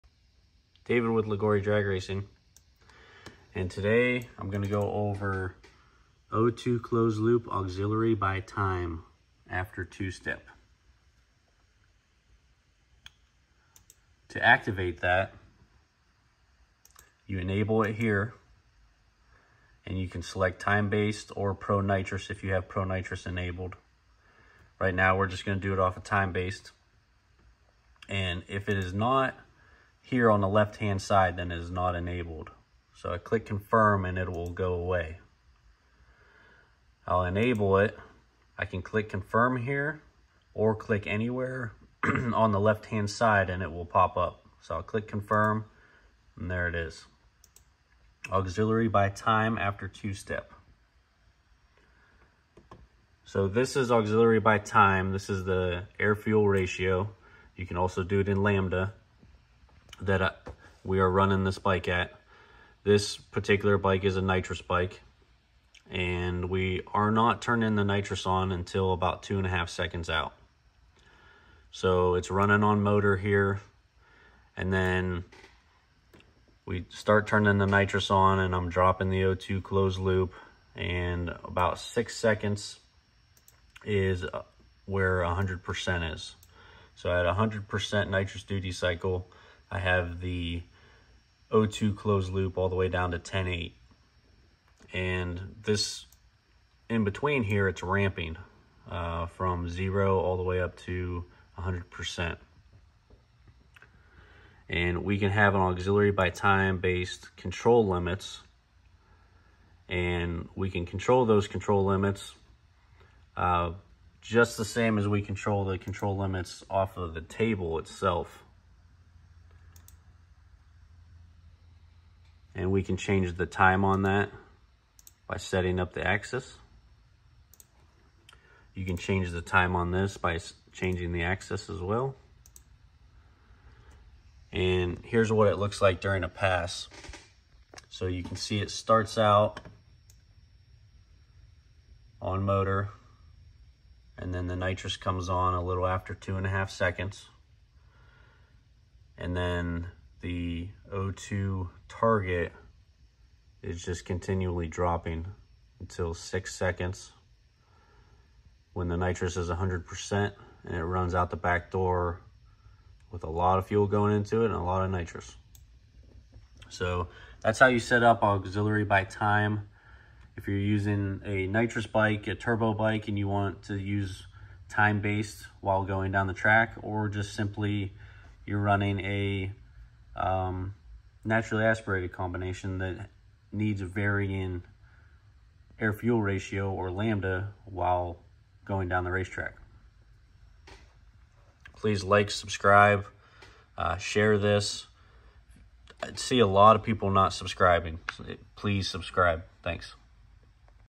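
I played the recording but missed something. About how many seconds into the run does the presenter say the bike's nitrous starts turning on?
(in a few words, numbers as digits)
2.5 seconds.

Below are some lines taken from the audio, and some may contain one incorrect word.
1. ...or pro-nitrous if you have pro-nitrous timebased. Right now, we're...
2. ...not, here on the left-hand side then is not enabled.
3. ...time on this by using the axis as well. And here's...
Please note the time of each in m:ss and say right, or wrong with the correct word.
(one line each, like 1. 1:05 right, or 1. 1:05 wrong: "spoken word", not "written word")
1. 0:21 wrong: "enabled", not "timebased"
2. 0:28 right
3. 2:09 wrong: "changing", not "using".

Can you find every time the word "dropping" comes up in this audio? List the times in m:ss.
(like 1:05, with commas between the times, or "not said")
1:18, 2:34.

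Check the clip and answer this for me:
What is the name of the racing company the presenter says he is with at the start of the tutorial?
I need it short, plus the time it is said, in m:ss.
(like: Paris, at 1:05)
Liguori Drag Racing, at 0:01.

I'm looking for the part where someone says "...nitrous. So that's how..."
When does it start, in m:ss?
2:44.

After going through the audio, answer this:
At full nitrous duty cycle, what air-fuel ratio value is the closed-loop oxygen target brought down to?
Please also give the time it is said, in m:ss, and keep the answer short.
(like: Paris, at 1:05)
10.8, at 1:33.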